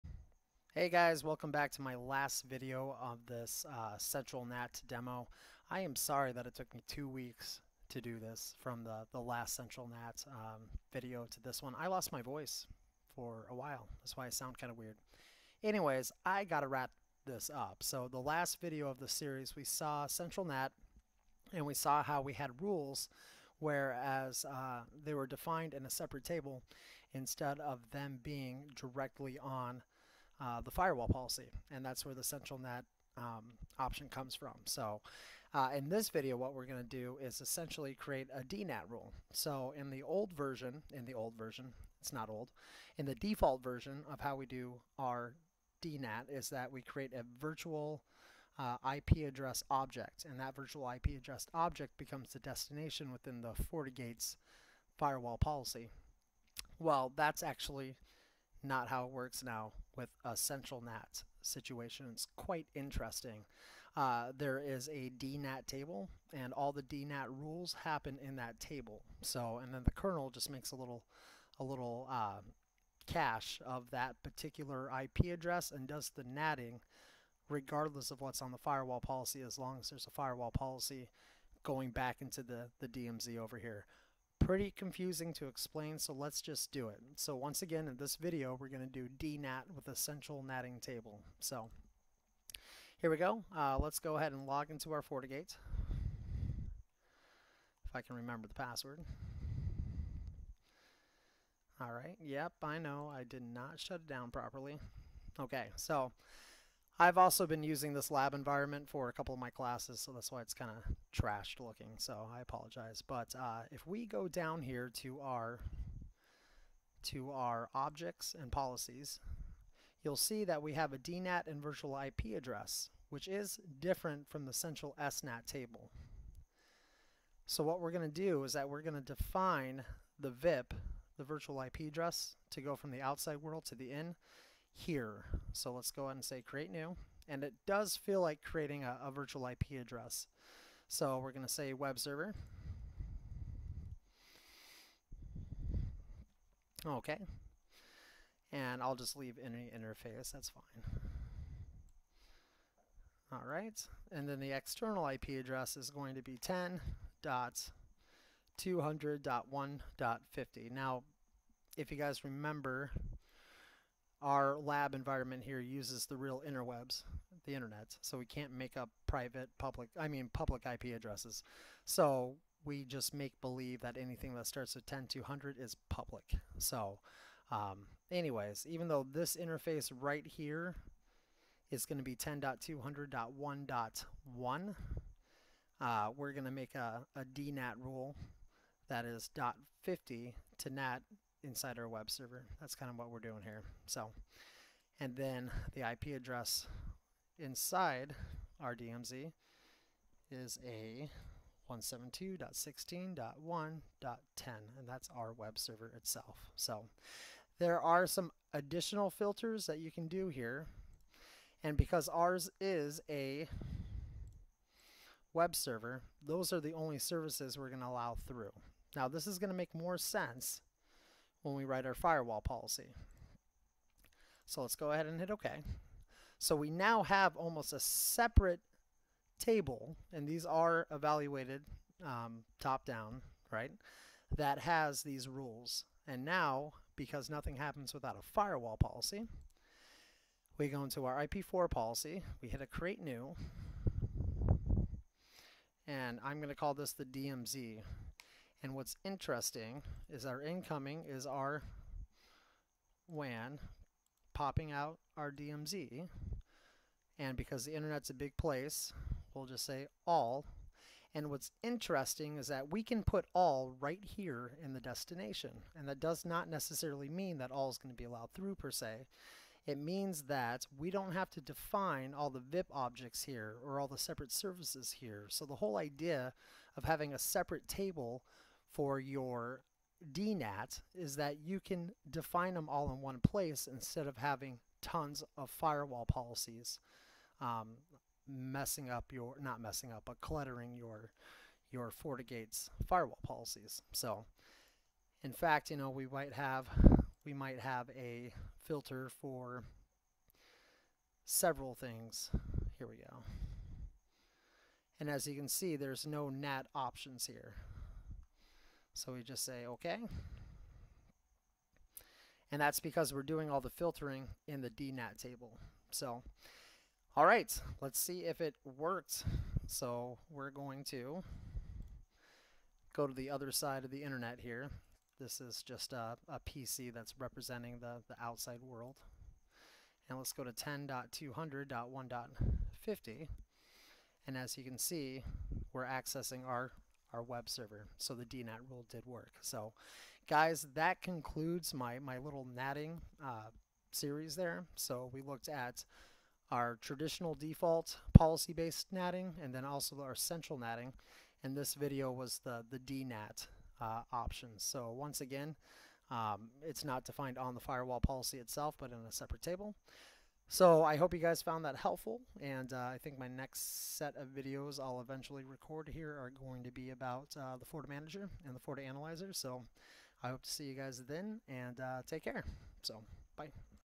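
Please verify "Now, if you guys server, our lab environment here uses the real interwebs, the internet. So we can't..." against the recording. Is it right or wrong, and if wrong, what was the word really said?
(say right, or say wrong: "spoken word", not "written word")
wrong: "remember", not "server".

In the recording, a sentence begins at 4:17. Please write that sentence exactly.
And because the internet's a big place, we'll just say all.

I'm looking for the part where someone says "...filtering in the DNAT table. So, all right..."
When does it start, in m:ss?
5:13.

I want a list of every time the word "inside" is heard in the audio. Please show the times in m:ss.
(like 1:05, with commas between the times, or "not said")
3:11, 3:17.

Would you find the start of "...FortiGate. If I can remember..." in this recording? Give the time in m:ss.
1:35.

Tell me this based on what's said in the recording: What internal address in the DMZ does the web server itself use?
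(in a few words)
172.16.1.10.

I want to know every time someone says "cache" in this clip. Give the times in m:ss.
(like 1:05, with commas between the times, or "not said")
1:13.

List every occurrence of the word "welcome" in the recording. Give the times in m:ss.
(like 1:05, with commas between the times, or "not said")
0:01.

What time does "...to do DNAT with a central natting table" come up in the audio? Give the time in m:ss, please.
1:28.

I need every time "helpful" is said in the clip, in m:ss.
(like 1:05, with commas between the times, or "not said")
6:01.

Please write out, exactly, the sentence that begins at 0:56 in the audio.
Well, that's actually not how it works now with a central NAT situation.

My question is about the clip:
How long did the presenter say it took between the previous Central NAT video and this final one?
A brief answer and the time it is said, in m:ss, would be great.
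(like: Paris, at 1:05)
two weeks, at 0:06.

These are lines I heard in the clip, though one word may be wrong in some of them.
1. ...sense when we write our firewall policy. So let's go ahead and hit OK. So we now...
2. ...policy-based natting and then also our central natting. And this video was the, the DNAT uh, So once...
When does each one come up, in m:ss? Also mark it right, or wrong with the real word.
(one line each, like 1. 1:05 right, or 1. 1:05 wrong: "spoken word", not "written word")
1. 3:39 right
2. 5:48 right.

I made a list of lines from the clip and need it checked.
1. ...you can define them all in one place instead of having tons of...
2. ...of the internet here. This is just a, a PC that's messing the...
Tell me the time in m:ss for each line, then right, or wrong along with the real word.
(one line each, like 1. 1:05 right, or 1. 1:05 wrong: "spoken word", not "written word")
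1. 4:41 right
2. 5:23 wrong: "representing", not "messing".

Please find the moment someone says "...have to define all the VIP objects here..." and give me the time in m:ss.
4:31.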